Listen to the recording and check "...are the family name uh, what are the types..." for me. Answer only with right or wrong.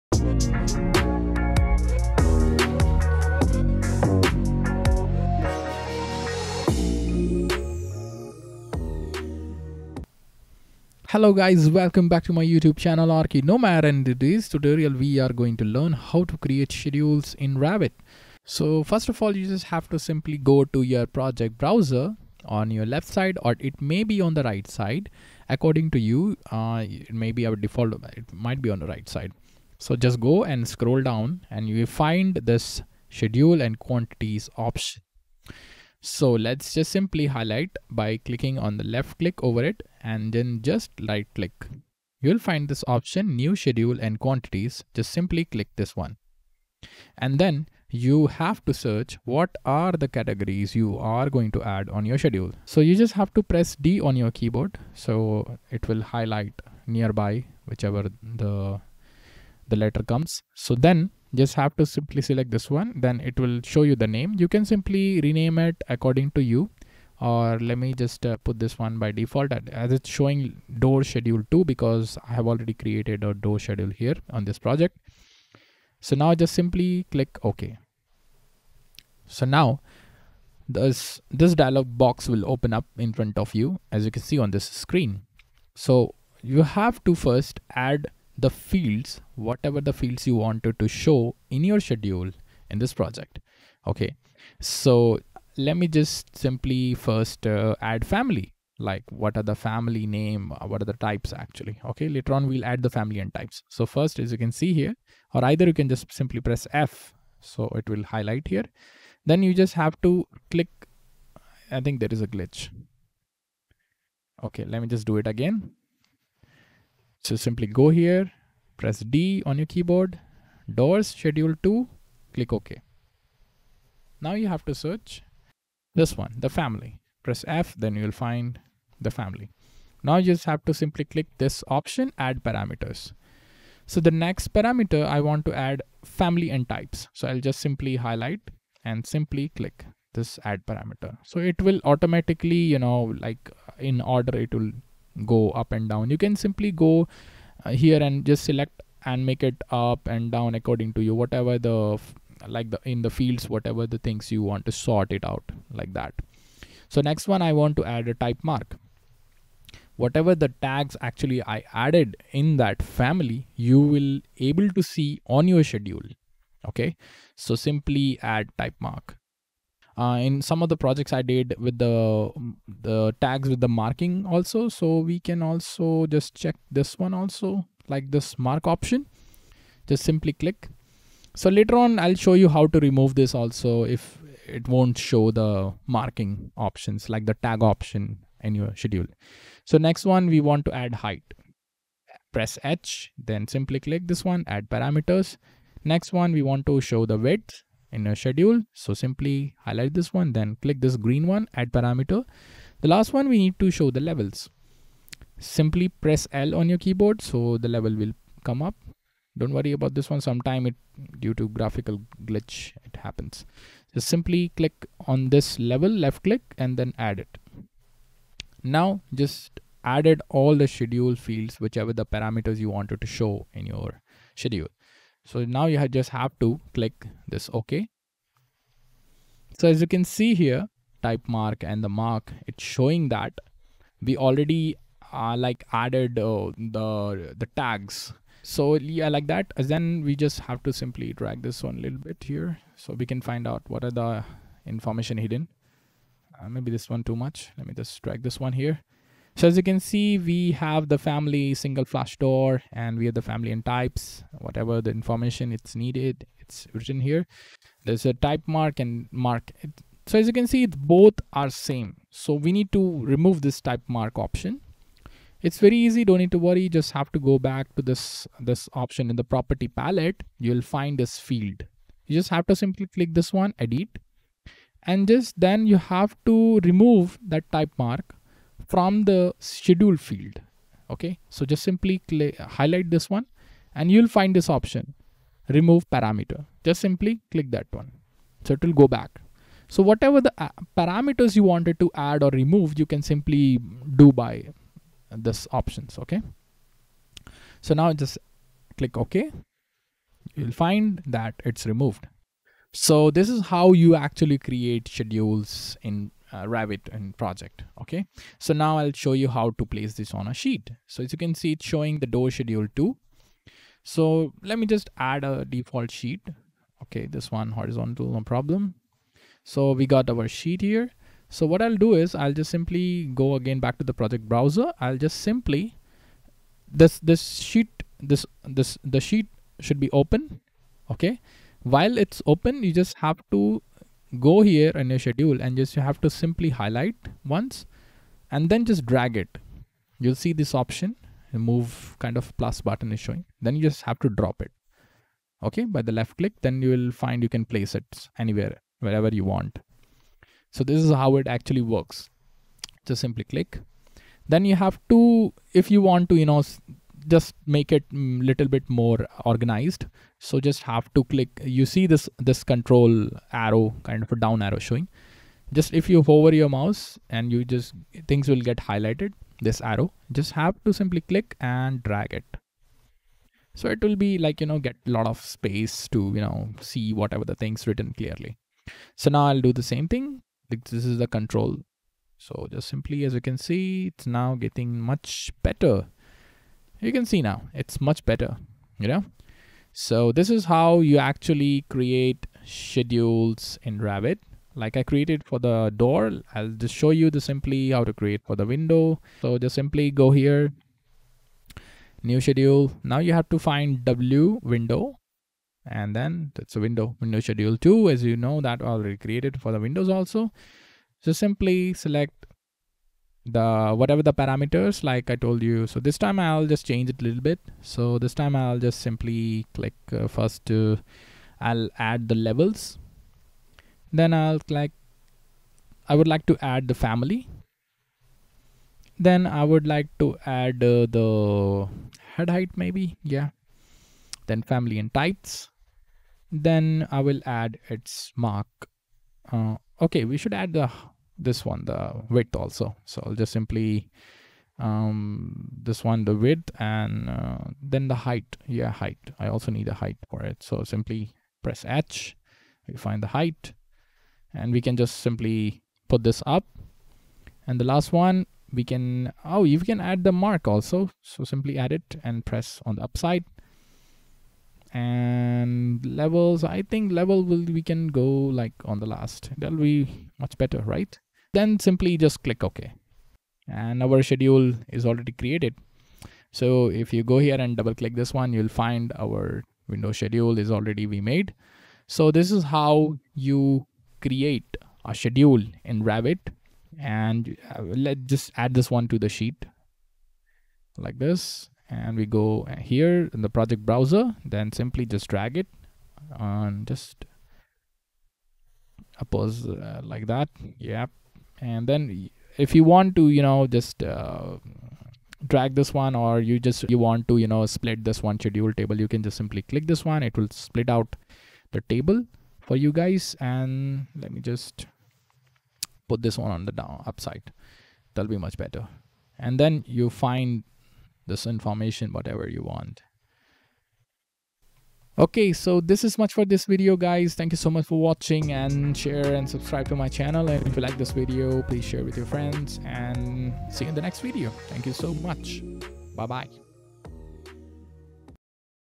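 right.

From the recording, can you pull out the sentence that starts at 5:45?
Okay, by the left click, then you will find you can place it anywhere, wherever you want.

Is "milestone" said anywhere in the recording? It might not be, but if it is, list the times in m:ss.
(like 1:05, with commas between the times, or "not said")
not said.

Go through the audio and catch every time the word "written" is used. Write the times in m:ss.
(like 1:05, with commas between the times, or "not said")
4:16, 6:17.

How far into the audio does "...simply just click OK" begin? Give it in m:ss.
7:51.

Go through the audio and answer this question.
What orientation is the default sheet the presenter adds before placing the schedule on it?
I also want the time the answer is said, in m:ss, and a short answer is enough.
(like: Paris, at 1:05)
Horizontal, at 5:17.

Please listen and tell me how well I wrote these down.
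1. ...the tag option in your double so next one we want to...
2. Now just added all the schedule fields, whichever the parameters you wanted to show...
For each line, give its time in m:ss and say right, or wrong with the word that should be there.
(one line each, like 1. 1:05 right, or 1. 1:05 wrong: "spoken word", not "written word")
1. 3:07 wrong: "schedule", not "double"
2. 3:38 right.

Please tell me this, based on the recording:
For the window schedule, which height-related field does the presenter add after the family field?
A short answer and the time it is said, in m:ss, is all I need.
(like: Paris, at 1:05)
Head height, at 7:12.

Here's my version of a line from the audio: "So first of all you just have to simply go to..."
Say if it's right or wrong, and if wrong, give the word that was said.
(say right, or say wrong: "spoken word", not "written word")
right.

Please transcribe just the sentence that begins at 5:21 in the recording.
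So what I'll do is I'll just simply go again back to the project browser.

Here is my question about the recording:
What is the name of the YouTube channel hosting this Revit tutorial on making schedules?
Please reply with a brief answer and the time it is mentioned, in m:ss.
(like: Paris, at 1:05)
Archi Nomad, at 0:13.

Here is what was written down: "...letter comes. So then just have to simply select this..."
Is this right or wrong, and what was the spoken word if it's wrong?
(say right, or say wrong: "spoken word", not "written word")
right.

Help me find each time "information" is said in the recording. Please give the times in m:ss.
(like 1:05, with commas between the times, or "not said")
4:04, 4:14, 8:41.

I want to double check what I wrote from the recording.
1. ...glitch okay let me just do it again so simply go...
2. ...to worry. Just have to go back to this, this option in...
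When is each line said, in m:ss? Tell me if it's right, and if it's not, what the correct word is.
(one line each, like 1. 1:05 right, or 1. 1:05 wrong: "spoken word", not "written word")
1. 1:52 right
2. 4:26 right.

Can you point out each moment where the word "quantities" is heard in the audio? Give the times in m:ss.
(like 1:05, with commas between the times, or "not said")
0:33, 0:44.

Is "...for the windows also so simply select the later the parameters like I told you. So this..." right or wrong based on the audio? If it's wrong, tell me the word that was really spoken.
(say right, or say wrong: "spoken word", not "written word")
wrong: "whatever", not "later".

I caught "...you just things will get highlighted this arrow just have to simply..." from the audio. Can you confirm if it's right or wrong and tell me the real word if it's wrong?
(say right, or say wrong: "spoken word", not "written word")
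right.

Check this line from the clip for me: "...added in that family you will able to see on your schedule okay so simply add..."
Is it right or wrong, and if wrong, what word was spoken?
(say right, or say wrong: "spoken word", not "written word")
right.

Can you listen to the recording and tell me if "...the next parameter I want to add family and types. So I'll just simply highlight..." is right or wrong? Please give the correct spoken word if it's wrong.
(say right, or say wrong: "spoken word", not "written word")
right.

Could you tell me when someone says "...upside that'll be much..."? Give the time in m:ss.
8:36.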